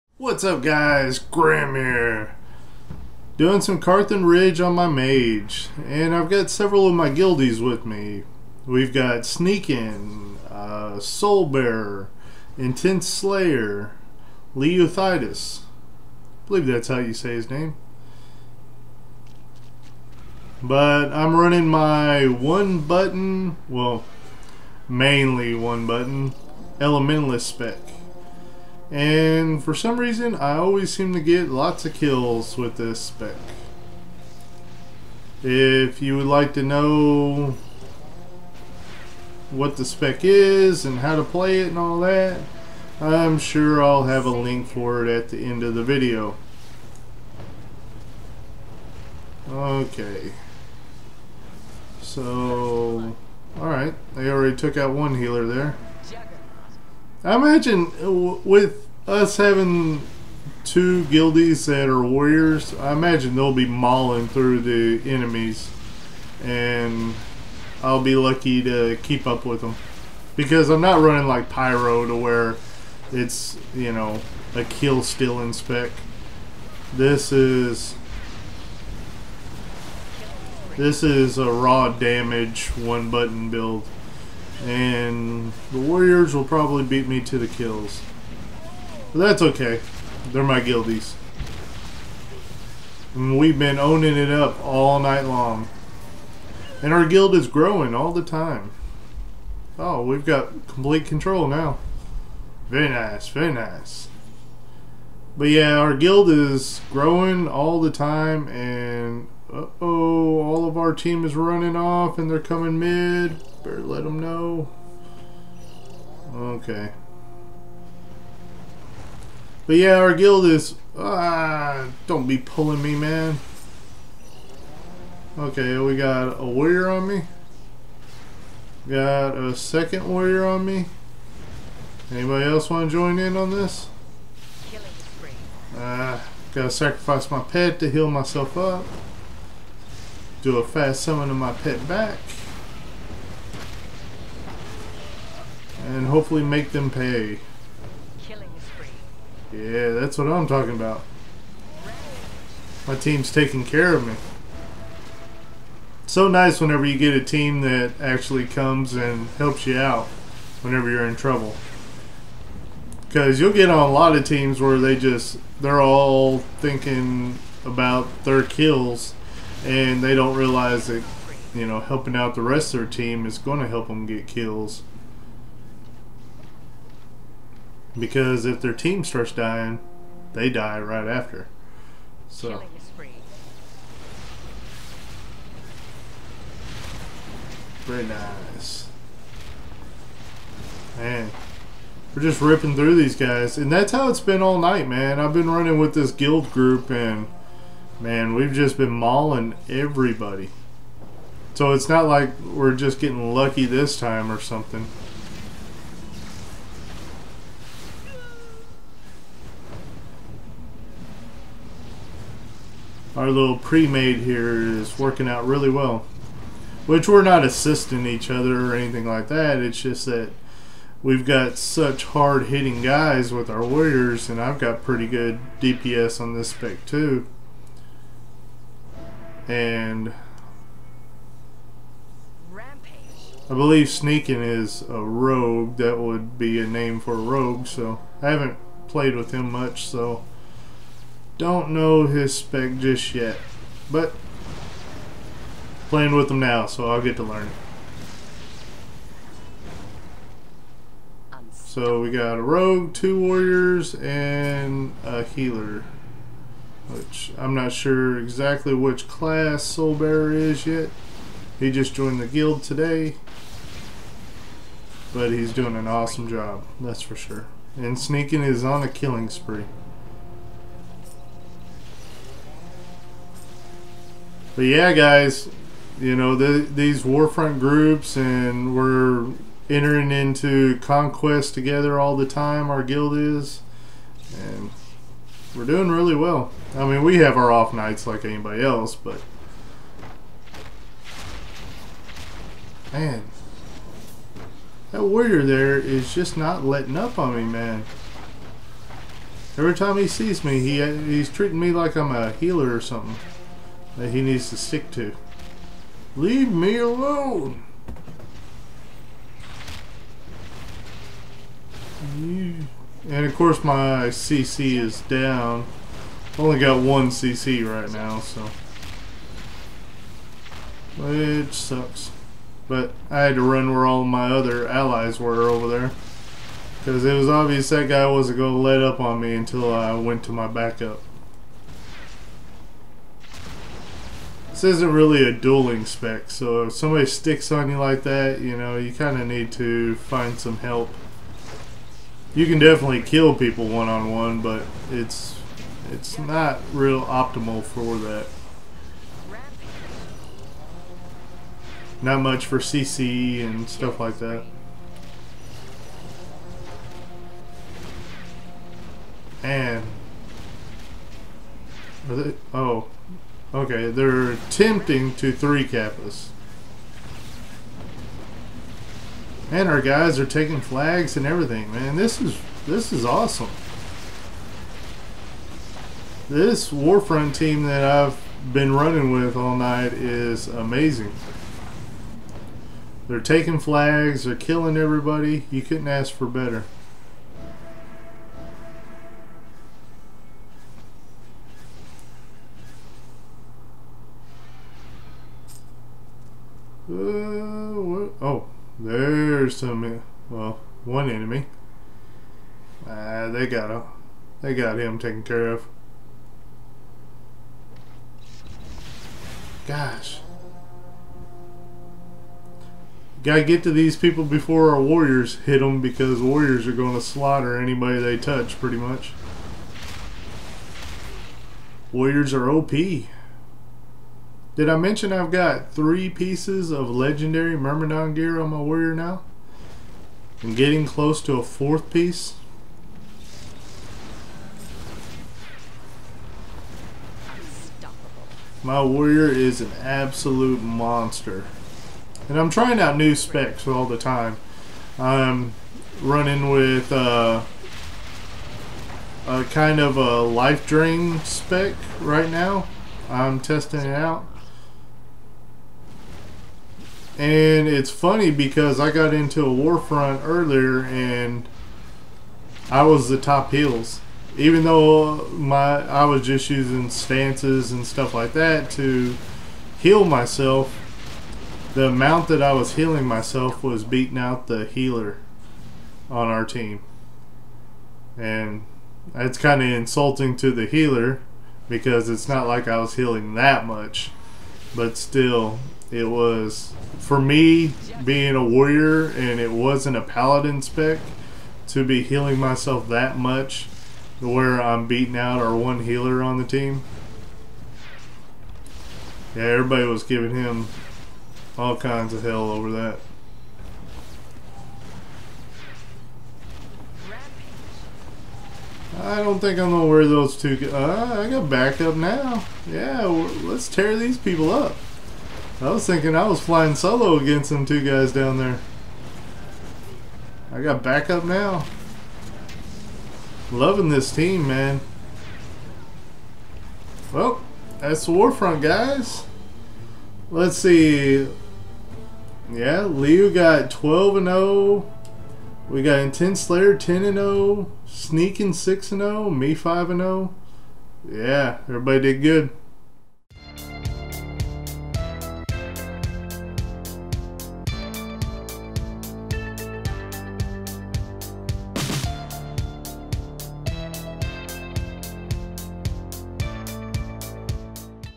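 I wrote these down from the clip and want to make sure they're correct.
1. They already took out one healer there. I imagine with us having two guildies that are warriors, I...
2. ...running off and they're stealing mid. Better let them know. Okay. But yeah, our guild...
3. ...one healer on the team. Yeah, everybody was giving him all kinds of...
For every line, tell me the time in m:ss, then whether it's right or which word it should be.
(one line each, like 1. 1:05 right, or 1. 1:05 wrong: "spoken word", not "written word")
1. 0:54 right
2. 1:51 wrong: "coming", not "stealing"
3. 8:15 right.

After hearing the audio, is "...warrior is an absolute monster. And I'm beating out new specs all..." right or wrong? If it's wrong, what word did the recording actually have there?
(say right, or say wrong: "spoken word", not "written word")
wrong: "trying", not "beating".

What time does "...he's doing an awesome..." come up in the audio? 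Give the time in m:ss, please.
4:25.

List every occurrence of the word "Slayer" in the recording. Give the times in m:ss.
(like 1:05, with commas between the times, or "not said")
0:13, 8:56.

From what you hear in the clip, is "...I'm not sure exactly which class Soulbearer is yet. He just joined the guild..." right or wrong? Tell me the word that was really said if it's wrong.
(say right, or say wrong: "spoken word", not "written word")
right.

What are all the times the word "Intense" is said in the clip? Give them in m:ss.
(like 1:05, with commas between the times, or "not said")
0:12, 8:55.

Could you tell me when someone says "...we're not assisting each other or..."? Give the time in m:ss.
3:37.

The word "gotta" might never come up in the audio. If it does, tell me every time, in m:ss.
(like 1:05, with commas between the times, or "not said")
2:16, 6:53.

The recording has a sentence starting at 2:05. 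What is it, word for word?
Okay, we got a warrior on me.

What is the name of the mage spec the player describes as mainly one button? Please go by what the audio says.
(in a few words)
Elementalist.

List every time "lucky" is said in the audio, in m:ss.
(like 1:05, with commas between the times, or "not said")
1:08, 3:23.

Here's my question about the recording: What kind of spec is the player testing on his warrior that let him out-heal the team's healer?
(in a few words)
life drain spec.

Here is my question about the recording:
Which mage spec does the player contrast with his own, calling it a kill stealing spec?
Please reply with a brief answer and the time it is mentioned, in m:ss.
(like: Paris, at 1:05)
Pyro, at 1:11.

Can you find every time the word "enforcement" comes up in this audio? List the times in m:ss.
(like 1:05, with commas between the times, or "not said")
not said.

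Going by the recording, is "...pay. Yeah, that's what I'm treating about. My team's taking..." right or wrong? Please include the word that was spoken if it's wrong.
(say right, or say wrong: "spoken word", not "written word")
wrong: "talking", not "treating".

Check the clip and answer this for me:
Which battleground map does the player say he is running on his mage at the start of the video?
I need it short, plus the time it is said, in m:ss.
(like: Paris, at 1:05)
Karthan Ridge, at 0:03.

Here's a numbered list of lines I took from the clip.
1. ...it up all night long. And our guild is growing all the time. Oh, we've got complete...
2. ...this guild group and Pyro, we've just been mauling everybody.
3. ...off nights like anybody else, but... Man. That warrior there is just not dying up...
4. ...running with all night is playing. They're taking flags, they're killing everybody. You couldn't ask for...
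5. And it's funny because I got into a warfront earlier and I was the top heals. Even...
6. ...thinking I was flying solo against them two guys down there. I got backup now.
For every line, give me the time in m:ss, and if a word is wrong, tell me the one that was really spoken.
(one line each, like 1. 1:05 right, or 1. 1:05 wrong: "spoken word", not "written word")
1. 1:34 right
2. 3:15 wrong: "Man", not "Pyro"
3. 4:47 wrong: "letting", not "dying"
4. 6:18 wrong: "amazing", not "playing"
5. 7:37 right
6. 8:35 right.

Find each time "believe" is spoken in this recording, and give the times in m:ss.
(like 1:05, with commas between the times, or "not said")
0:16, 3:53.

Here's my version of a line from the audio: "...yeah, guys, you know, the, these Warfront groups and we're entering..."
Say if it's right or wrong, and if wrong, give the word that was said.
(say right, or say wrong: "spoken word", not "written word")
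right.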